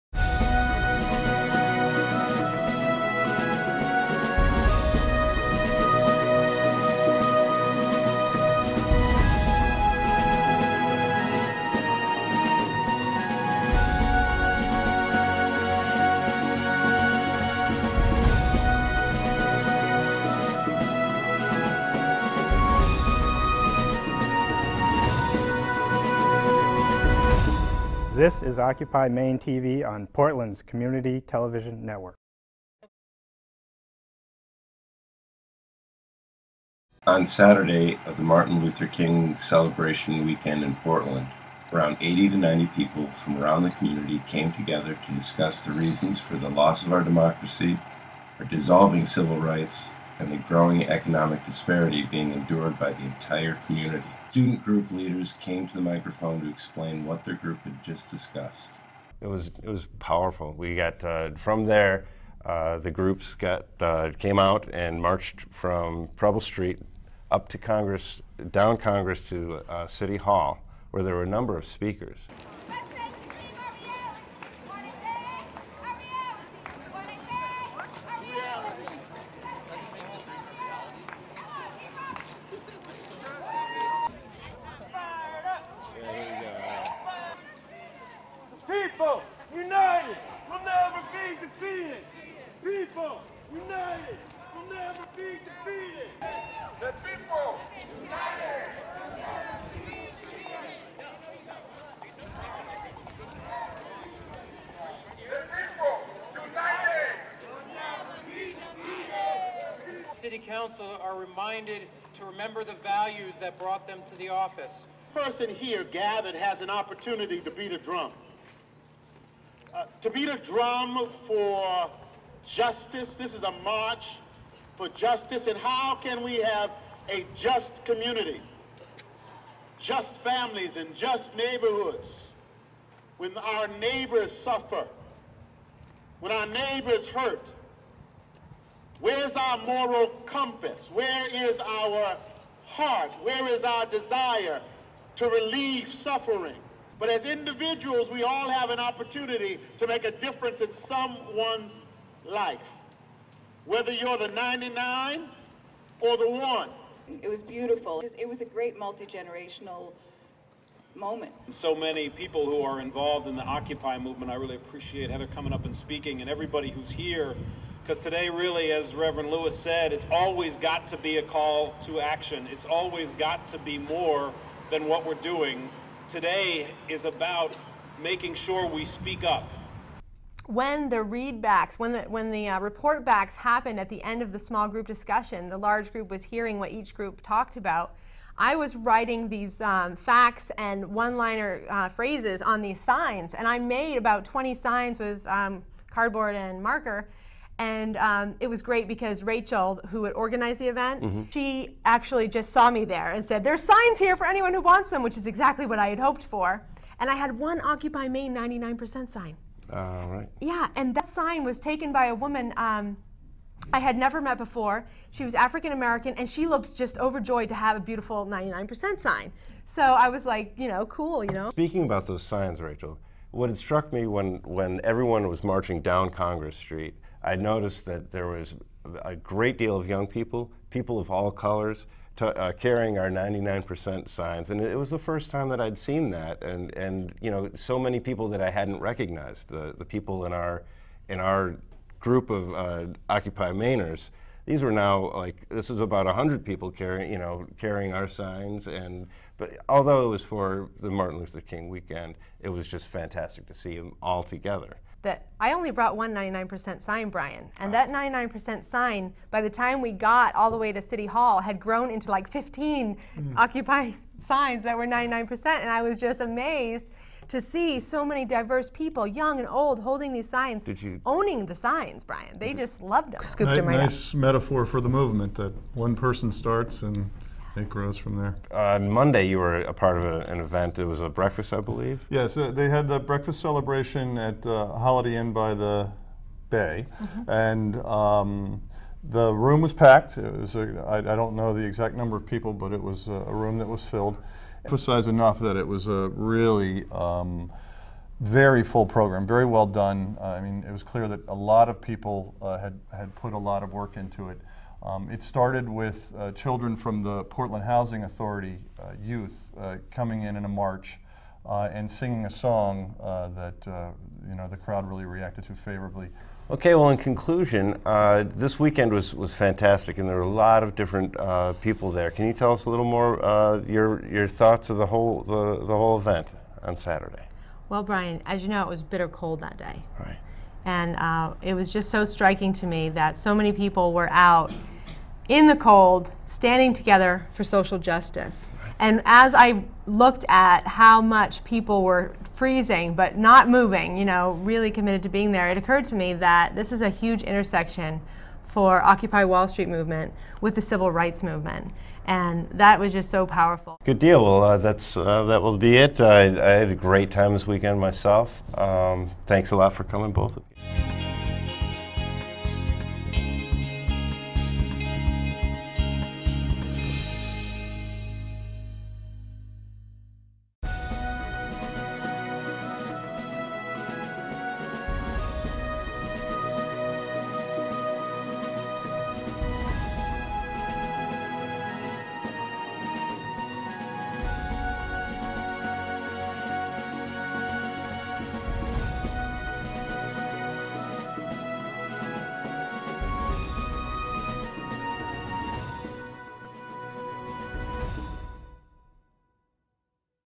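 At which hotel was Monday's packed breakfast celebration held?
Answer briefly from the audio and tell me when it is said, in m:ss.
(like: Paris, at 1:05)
Holiday Inn by the Bay, at 4:44.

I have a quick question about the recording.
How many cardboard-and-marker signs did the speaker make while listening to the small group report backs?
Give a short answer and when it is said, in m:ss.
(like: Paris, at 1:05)
20, at 3:14.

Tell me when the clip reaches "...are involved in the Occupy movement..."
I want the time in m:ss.
2:42.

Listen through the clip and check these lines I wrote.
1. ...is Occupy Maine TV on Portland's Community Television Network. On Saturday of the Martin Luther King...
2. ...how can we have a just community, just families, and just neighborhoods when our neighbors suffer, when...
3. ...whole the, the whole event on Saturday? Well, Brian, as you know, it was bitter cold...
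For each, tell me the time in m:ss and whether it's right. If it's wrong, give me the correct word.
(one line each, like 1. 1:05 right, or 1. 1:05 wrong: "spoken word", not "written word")
1. 0:28 right
2. 2:05 right
3. 5:24 right.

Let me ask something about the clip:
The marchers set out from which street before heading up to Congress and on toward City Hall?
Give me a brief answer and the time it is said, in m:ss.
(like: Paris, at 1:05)
Preble Street, at 1:06.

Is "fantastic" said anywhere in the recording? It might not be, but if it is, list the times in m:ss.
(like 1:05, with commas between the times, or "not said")
4:12, 5:19.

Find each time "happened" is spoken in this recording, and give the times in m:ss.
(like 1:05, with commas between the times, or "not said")
3:03.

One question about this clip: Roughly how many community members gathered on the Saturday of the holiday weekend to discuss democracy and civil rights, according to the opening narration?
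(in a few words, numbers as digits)
80 to 90.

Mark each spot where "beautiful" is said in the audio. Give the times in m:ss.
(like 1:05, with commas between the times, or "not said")
2:37, 3:37.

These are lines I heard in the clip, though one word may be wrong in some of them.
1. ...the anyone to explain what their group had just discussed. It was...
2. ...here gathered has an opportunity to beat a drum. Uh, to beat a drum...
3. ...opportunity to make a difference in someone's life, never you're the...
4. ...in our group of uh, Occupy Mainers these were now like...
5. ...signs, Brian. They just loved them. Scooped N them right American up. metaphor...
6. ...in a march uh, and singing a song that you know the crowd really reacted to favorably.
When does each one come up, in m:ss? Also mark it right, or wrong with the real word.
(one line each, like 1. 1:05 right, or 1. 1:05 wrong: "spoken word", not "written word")
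1. 0:55 wrong: "microphone", not "anyone"
2. 1:55 right
3. 2:28 wrong: "whether", not "never"
4. 4:01 right
5. 4:31 wrong: "Nice", not "American"
6. 5:10 right.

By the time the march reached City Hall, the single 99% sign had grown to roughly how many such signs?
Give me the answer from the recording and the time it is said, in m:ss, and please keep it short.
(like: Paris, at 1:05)
15, at 4:22.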